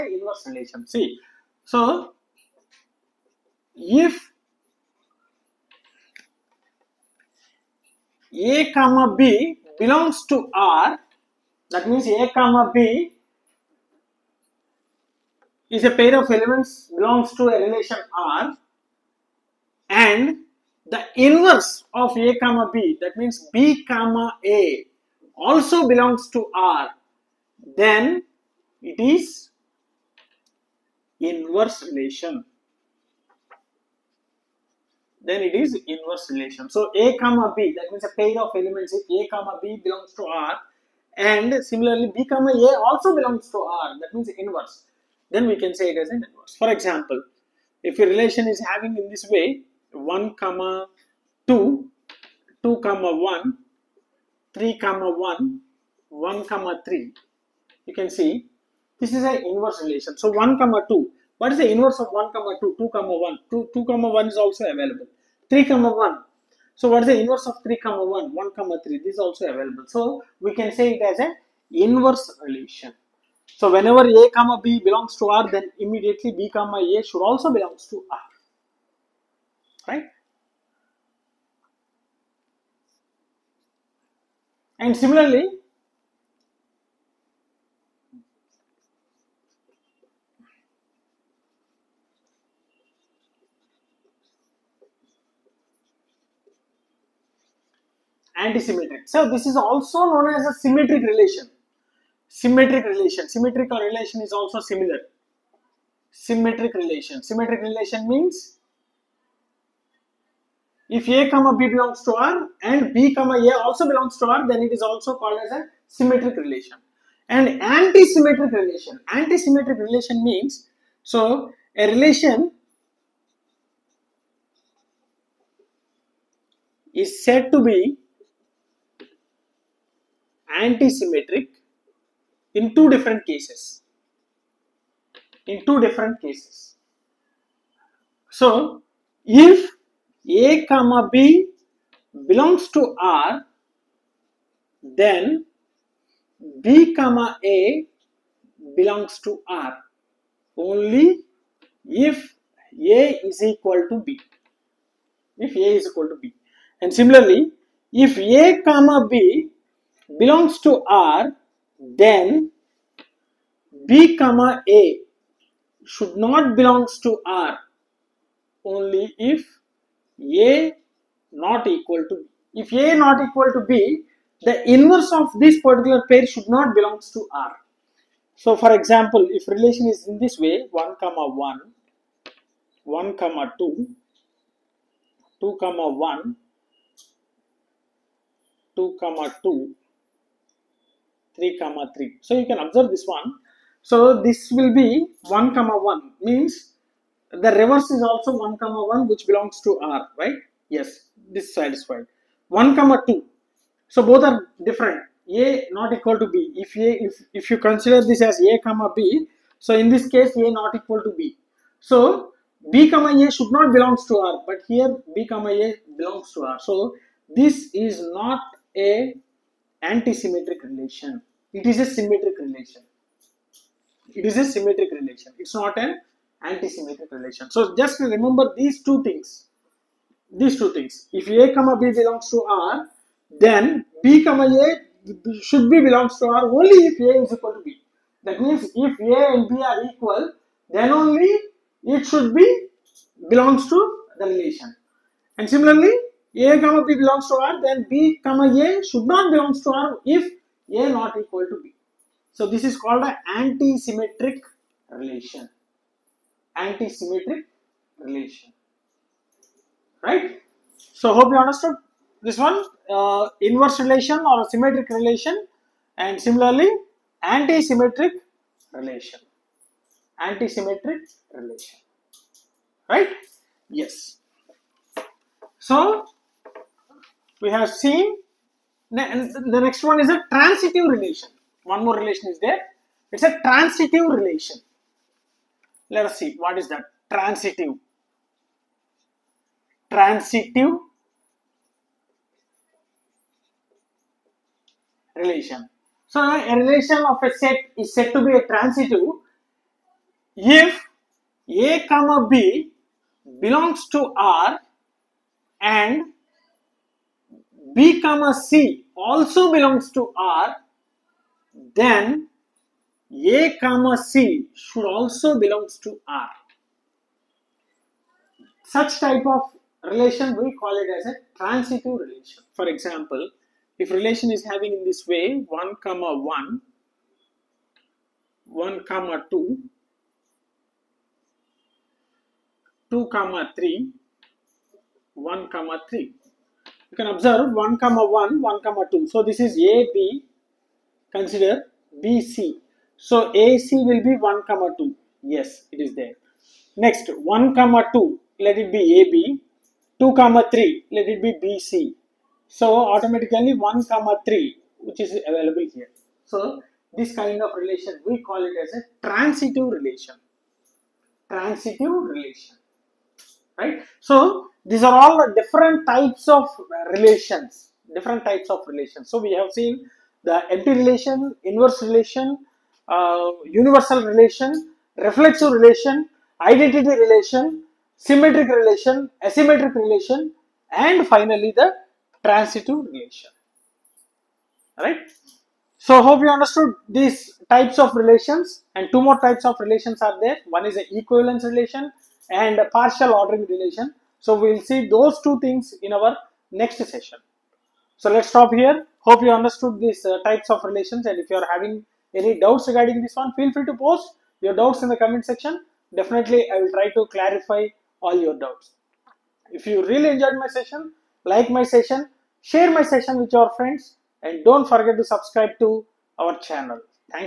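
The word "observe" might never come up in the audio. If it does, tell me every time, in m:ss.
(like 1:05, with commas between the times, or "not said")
3:12, 5:37.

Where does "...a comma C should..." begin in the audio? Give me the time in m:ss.
5:13.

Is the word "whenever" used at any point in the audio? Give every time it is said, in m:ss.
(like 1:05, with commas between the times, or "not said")
1:13.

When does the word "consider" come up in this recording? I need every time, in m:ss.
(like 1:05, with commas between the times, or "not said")
3:27, 5:41.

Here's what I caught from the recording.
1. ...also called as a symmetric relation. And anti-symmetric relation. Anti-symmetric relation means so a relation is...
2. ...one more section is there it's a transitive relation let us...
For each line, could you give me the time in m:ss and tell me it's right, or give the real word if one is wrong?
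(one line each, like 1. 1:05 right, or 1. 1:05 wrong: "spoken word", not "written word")
1. 1:54 right
2. 4:41 wrong: "relation", not "section".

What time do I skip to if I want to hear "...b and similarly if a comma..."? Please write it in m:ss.
2:36.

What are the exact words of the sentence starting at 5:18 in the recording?
Such type of relation we call it as a transitive relation.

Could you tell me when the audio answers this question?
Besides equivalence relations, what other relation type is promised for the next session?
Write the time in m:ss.
6:32.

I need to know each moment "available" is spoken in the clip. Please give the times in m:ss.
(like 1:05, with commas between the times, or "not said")
1:04, 1:09, 5:55.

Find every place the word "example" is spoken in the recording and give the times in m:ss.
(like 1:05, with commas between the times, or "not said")
0:46, 2:58, 5:22.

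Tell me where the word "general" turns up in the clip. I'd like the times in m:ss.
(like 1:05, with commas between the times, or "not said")
not said.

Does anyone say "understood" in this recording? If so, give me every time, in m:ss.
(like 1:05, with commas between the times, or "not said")
4:21, 6:26, 6:39.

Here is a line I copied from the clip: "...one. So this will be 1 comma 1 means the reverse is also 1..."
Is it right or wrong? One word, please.
right.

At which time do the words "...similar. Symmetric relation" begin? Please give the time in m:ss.
1:44.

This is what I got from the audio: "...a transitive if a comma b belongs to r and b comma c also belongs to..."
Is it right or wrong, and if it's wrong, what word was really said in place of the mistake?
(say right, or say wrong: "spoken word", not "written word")
right.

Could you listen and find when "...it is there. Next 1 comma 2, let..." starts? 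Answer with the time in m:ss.
5:45.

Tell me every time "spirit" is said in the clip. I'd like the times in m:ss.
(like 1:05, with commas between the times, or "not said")
not said.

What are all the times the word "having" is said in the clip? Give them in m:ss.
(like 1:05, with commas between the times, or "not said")
0:48, 5:24, 6:41.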